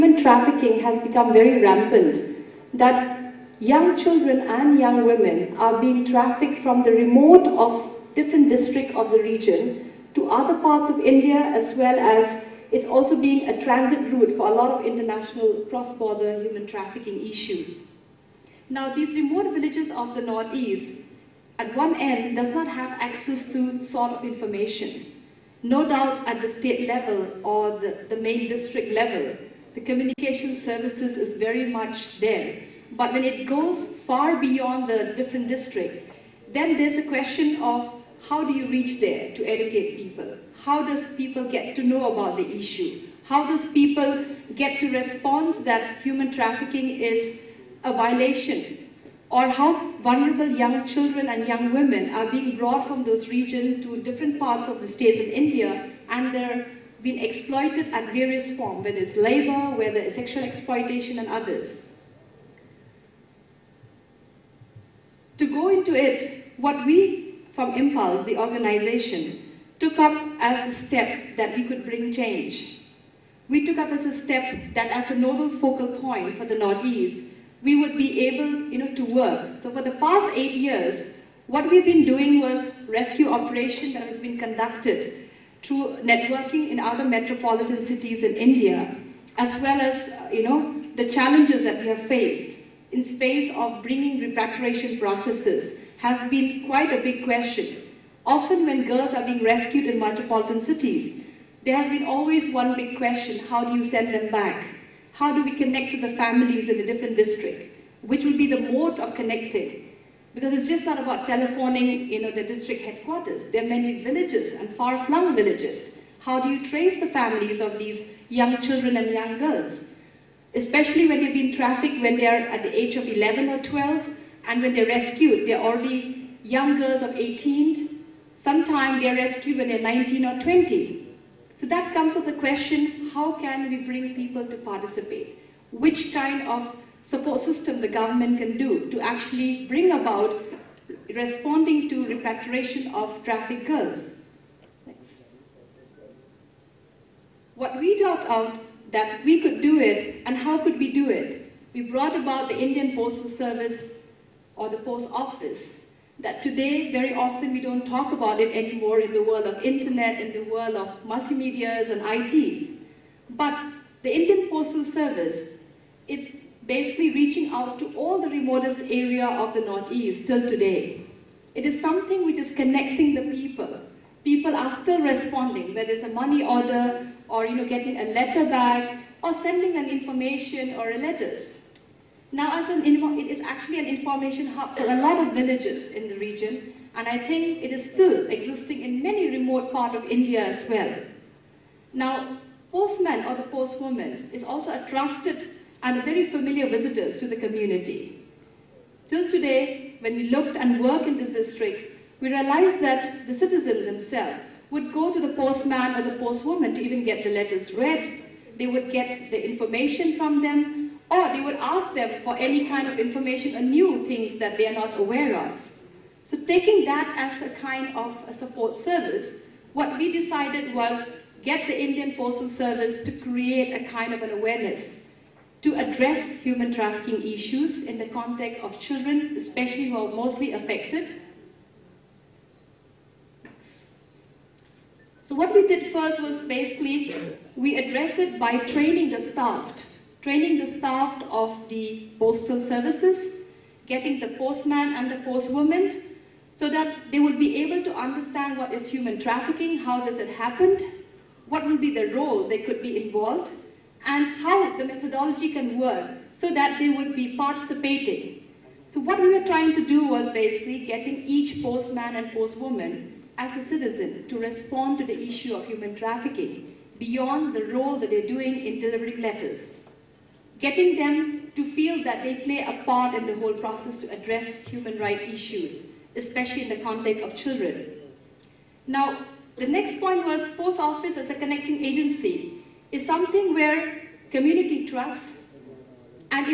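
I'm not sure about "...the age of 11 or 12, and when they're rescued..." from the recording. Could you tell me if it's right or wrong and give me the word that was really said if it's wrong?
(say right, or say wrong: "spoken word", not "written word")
right.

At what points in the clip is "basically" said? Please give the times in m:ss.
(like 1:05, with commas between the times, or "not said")
2:46, 3:56, 4:20.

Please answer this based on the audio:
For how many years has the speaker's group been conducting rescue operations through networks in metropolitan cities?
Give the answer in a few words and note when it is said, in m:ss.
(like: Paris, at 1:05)
8, at 1:20.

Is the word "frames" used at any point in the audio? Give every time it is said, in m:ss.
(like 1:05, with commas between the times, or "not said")
not said.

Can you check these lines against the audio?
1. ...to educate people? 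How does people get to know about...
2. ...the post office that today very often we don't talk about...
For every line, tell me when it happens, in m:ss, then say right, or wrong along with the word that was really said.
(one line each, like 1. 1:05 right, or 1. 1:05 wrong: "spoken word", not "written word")
1. 0:39 right
2. 2:34 right.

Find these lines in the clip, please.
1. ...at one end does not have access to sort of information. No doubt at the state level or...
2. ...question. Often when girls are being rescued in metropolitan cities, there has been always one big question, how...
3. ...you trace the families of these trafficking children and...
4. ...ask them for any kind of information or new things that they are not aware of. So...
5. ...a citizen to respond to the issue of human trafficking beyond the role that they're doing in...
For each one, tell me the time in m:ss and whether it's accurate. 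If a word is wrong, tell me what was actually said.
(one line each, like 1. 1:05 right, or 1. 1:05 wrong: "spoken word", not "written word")
1. 0:21 right
2. 1:37 right
3. 1:56 wrong: "young", not "trafficking"
4. 3:31 right
5. 4:23 right.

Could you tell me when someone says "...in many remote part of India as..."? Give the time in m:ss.
3:08.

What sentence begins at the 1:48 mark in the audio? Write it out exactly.
Which will be the mode of connecting?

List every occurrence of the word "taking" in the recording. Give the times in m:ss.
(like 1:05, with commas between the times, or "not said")
3:36.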